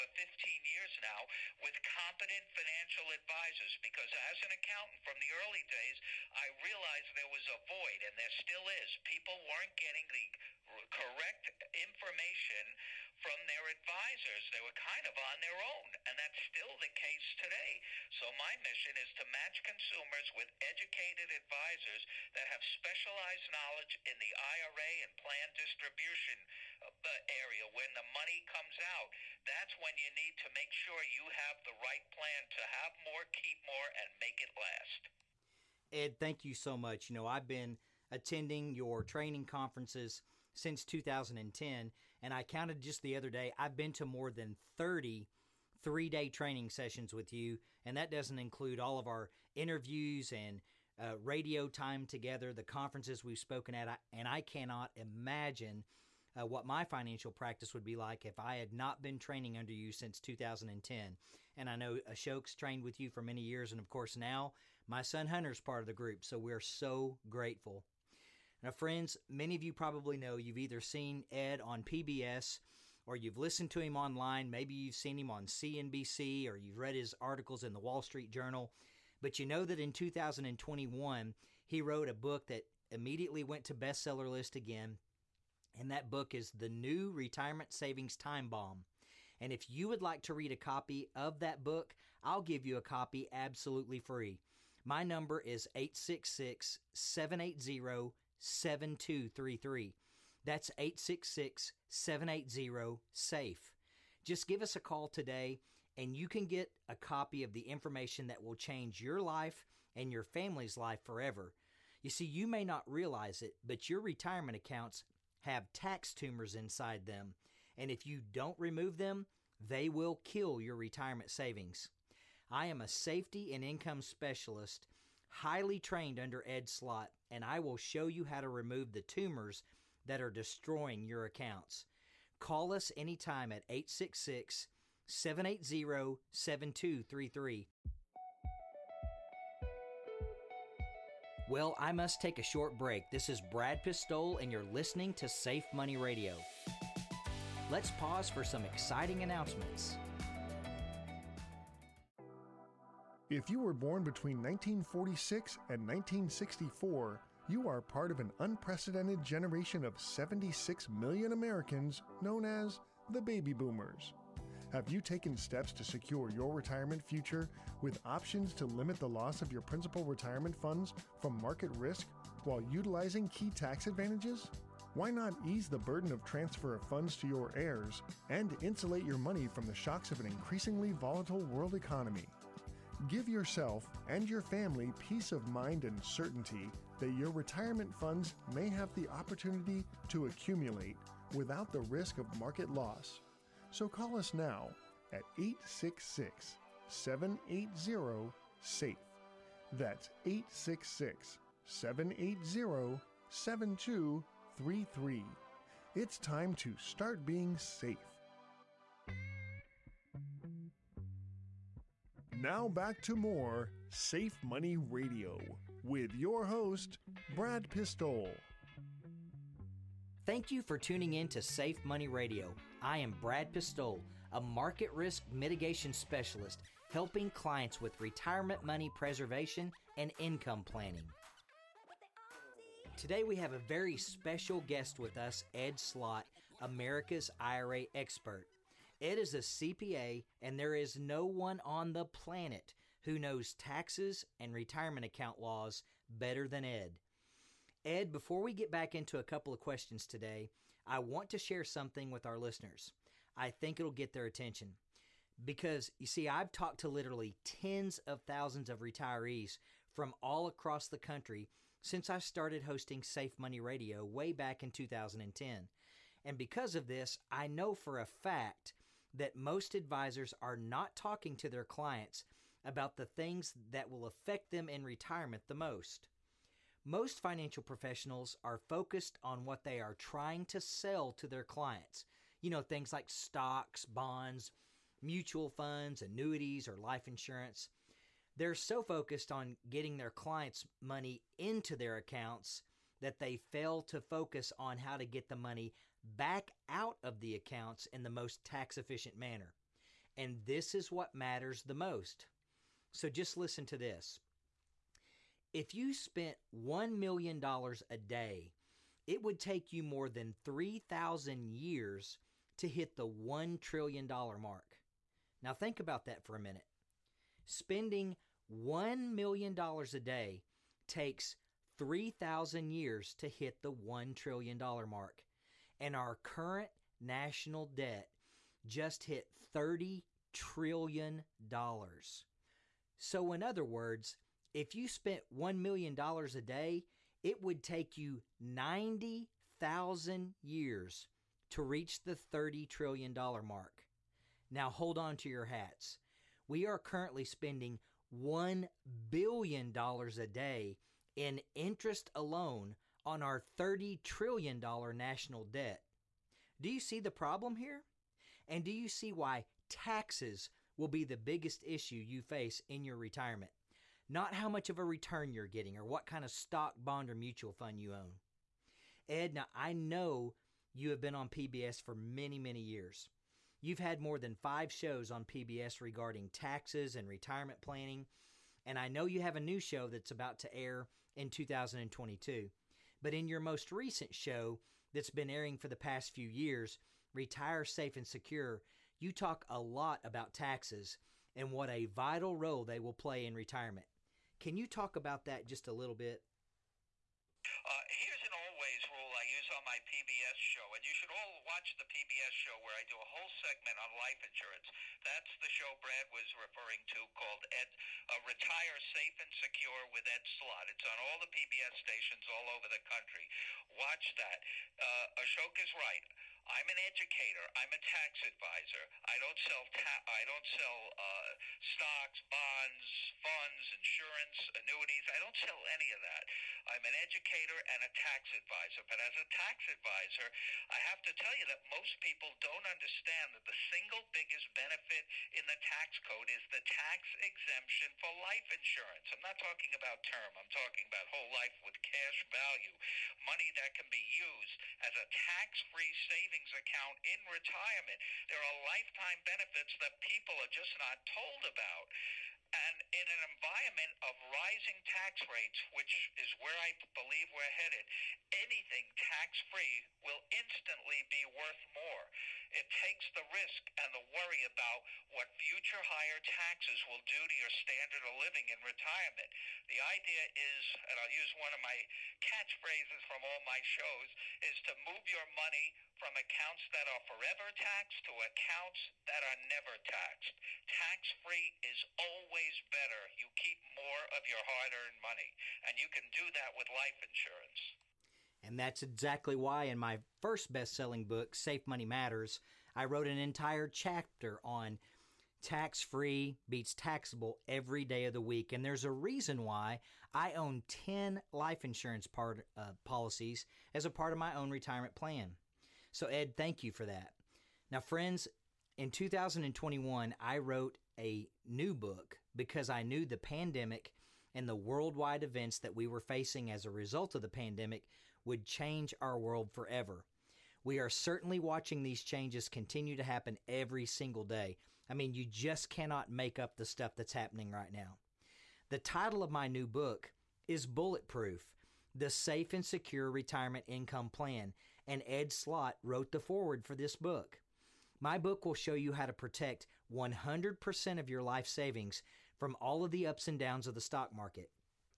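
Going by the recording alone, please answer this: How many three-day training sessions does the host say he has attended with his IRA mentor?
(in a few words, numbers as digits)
more than 30.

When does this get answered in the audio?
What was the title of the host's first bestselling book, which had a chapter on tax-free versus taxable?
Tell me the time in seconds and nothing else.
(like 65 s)
491 s.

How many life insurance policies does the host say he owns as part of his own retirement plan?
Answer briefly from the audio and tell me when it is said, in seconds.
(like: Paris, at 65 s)
10, at 500 s.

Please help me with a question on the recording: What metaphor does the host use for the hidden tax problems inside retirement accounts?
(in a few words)
tax tumors.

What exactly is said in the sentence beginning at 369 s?
Ed, now I know you have been on PBS for many, many years.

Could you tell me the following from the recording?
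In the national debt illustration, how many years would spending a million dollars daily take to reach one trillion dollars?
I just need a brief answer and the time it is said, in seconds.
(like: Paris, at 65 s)
more than 3,000 years, at 309 s.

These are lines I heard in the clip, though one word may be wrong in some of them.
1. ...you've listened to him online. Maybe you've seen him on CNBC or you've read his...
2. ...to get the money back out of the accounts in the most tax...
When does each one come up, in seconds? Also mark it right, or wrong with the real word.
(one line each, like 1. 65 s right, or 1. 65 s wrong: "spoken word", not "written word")
1. 73 s right
2. 294 s right.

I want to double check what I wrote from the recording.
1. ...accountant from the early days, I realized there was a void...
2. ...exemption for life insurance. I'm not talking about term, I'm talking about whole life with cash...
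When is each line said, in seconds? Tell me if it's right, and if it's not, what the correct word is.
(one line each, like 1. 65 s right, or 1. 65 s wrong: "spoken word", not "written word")
1. 4 s right
2. 437 s right.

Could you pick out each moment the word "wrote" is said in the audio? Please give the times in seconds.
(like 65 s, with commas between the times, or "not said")
81 s, 492 s, 510 s, 535 s.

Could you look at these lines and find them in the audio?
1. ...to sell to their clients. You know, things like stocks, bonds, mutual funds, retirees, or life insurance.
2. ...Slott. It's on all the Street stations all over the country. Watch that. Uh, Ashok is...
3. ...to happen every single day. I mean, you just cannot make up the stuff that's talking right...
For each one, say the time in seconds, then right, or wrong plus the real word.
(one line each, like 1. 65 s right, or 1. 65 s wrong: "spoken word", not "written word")
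1. 280 s wrong: "annuities", not "retirees"
2. 410 s wrong: "PBS", not "Street"
3. 522 s wrong: "happening", not "talking".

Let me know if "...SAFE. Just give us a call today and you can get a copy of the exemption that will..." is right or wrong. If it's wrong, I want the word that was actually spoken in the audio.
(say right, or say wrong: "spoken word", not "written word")
wrong: "information", not "exemption".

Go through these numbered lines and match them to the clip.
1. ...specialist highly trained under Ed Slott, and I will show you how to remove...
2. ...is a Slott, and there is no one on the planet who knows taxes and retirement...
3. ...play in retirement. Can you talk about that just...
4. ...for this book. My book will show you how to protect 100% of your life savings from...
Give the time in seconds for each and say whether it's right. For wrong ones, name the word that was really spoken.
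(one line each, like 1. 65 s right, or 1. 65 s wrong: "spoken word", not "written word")
1. 124 s right
2. 239 s wrong: "CPA", not "Slott"
3. 392 s right
4. 536 s right.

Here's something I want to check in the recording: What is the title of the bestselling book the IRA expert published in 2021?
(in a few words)
The New Retirement Savings Time Bomb.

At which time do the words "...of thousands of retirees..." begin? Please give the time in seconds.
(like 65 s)
257 s.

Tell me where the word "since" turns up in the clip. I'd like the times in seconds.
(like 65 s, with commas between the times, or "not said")
40 s, 59 s, 261 s.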